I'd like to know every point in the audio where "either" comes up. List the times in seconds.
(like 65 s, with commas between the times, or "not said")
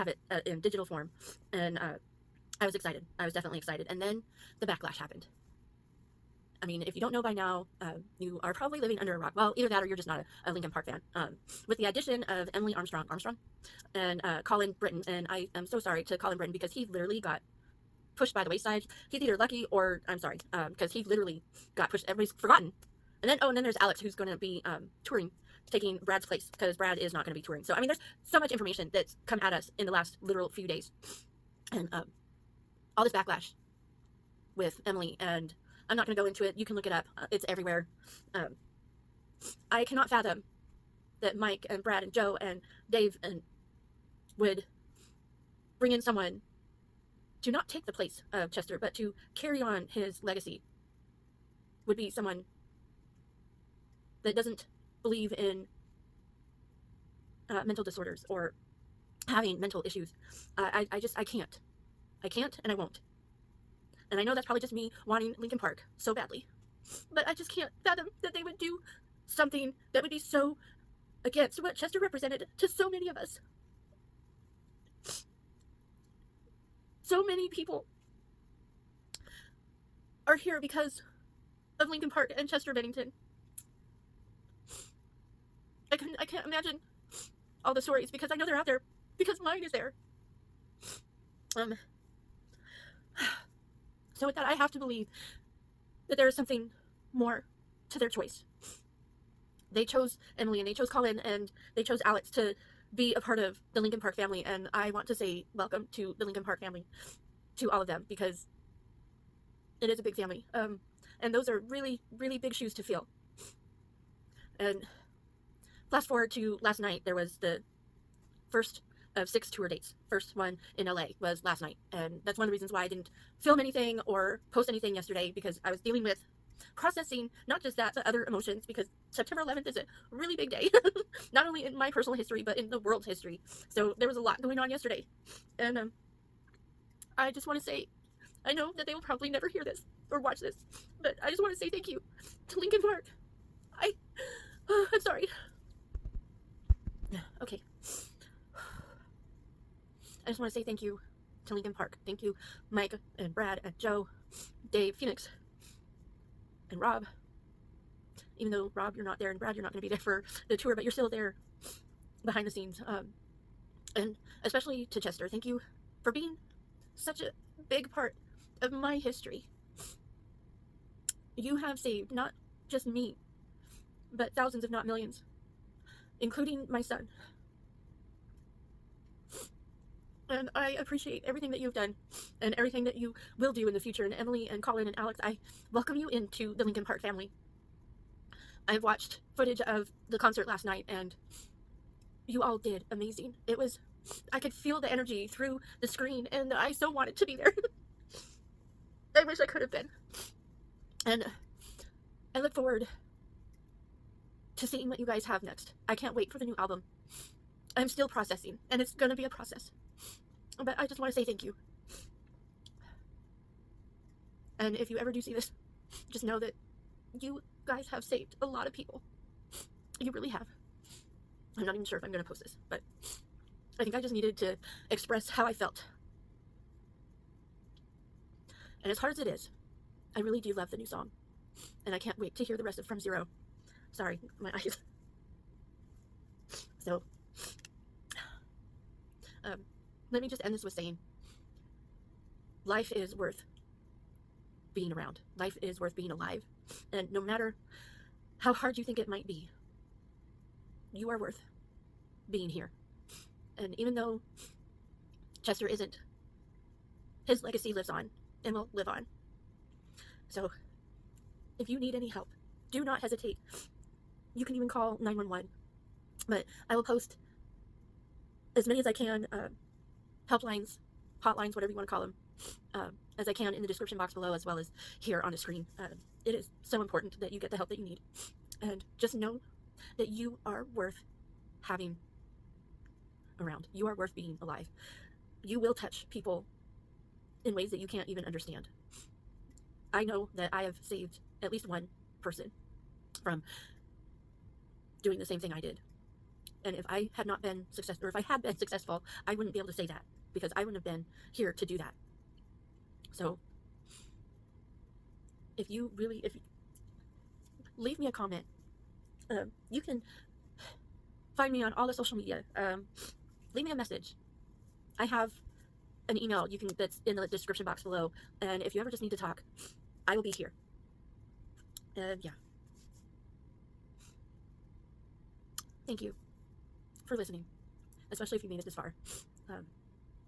9 s, 19 s.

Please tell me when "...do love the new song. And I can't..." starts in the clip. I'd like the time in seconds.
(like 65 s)
230 s.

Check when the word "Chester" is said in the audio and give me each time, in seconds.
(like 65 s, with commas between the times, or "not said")
48 s, 71 s, 82 s, 164 s, 255 s.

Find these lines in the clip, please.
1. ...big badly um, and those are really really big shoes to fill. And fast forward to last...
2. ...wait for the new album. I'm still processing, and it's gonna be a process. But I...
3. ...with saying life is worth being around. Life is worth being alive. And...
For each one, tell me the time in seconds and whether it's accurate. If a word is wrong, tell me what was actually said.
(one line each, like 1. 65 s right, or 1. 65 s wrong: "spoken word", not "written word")
1. 110 s wrong: "family", not "badly"
2. 206 s right
3. 240 s right.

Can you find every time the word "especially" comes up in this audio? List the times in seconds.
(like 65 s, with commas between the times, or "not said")
164 s, 328 s.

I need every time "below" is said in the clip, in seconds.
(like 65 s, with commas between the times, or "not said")
274 s, 317 s.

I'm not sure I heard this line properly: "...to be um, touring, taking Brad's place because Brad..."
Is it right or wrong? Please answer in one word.
right.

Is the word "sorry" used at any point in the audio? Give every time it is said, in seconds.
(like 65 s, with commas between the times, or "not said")
15 s, 20 s, 145 s, 233 s.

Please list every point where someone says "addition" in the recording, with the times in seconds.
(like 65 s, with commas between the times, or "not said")
11 s.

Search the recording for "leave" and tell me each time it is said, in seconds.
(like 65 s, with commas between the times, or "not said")
307 s, 313 s.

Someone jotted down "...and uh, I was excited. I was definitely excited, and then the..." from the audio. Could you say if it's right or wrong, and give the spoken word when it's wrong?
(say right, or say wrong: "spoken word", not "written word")
right.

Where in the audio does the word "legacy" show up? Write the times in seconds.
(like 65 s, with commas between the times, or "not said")
50 s, 257 s.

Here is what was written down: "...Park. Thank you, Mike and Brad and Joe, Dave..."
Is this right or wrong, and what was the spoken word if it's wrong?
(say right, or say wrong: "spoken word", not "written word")
right.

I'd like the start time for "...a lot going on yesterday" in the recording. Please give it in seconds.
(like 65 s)
134 s.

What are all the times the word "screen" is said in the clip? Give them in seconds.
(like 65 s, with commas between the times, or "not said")
195 s, 275 s.